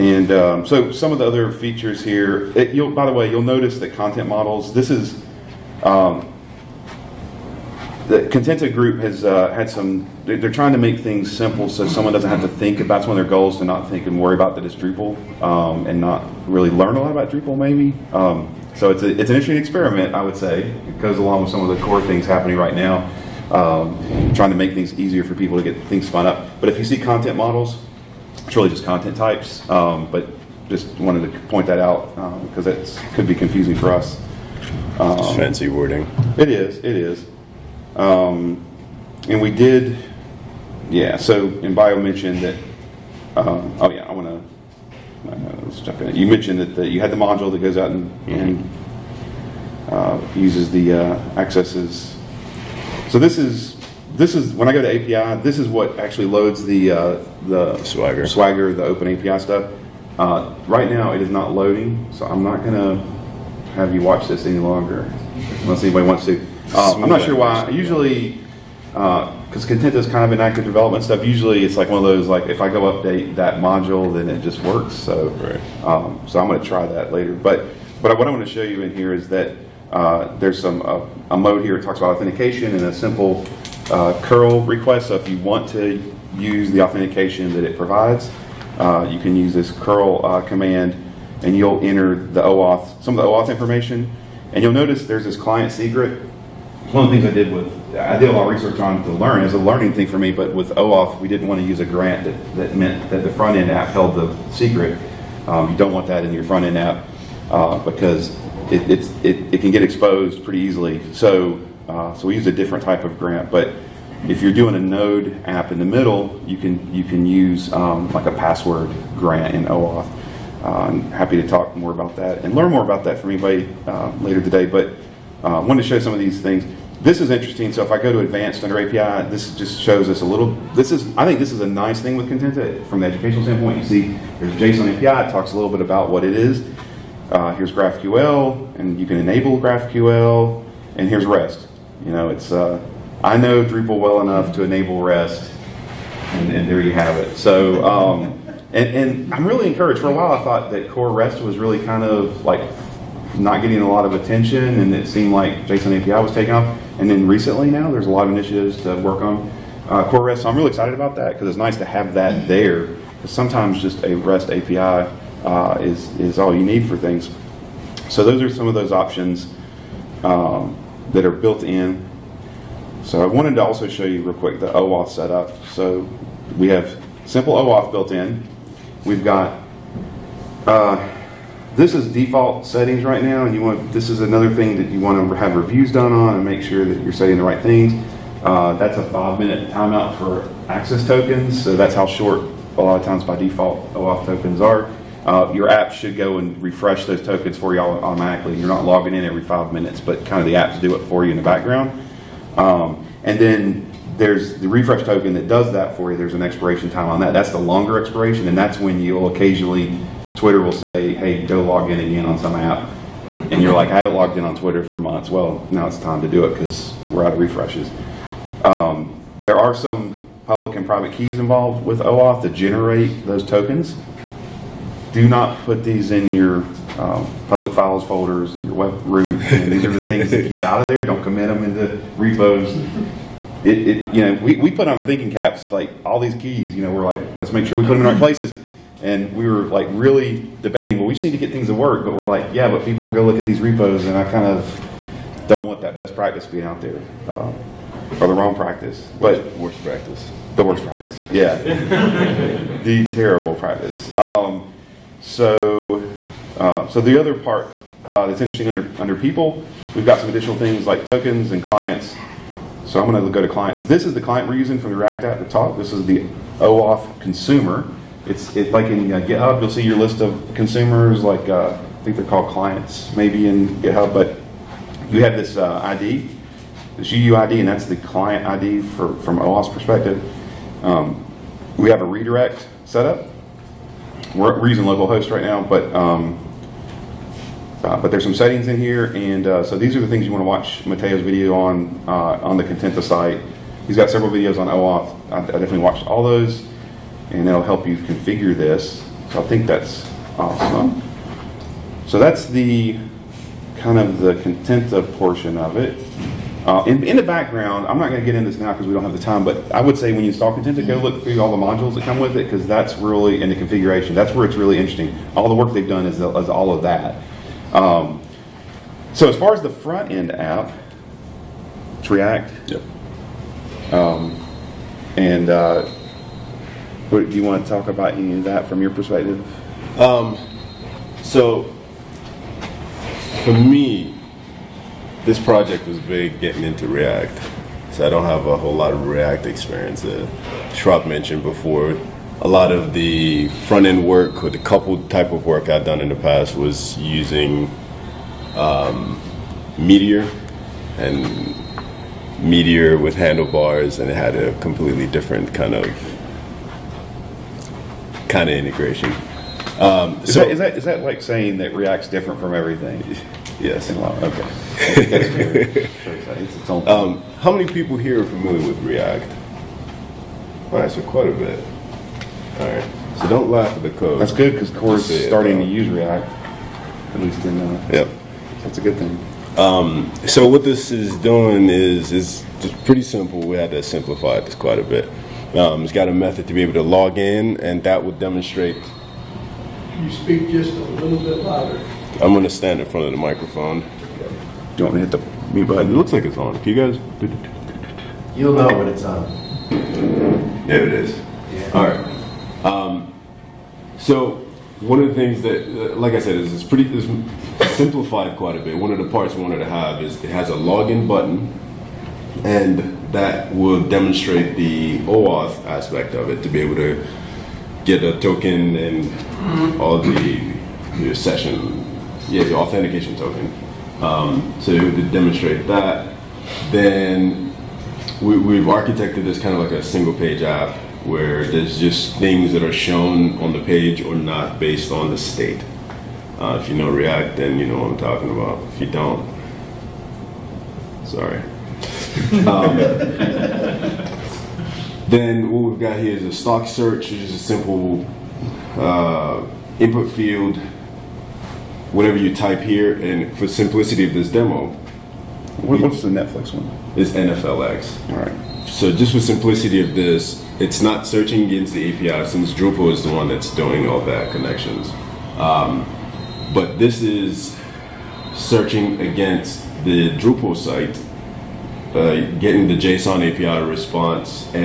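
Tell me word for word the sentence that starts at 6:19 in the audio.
Um, so what this is doing is is just pretty simple.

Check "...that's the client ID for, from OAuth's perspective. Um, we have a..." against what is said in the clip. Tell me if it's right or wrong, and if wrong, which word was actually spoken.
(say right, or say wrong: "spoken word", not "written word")
right.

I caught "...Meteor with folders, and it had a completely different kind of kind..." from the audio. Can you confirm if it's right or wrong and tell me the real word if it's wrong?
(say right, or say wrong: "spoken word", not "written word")
wrong: "handlebars", not "folders".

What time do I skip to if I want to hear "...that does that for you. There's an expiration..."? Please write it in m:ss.
3:25.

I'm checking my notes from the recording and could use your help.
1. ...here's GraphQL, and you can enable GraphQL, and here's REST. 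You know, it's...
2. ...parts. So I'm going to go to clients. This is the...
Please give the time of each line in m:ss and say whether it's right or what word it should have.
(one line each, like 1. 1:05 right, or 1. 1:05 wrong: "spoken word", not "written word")
1. 2:17 right
2. 4:21 wrong: "clients", not "parts".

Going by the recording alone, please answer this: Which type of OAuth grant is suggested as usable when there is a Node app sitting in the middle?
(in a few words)
password grant.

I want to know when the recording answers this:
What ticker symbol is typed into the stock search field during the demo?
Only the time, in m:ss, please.
7:37.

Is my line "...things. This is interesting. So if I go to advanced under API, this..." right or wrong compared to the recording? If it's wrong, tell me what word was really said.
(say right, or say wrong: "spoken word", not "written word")
right.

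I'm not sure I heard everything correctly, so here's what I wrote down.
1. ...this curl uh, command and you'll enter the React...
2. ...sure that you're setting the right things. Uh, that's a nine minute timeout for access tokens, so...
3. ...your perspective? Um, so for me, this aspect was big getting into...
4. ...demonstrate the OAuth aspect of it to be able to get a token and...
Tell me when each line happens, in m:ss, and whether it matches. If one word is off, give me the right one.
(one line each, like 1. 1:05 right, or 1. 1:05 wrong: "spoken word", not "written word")
1. 1:29 wrong: "OAuth", not "React"
2. 3:06 wrong: "five", not "nine"
3. 5:28 wrong: "project", not "aspect"
4. 6:53 right.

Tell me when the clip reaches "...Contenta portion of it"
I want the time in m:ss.
5:04.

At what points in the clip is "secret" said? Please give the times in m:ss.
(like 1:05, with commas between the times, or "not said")
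1:35, 1:44.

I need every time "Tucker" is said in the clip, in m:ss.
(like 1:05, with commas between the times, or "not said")
not said.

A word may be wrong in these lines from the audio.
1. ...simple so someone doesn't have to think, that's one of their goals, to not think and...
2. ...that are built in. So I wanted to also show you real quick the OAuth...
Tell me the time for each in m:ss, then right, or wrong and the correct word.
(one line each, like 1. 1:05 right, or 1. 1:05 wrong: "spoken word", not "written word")
1. 0:11 right
2. 2:51 right.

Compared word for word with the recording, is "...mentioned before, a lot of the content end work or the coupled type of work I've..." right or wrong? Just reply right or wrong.
wrong.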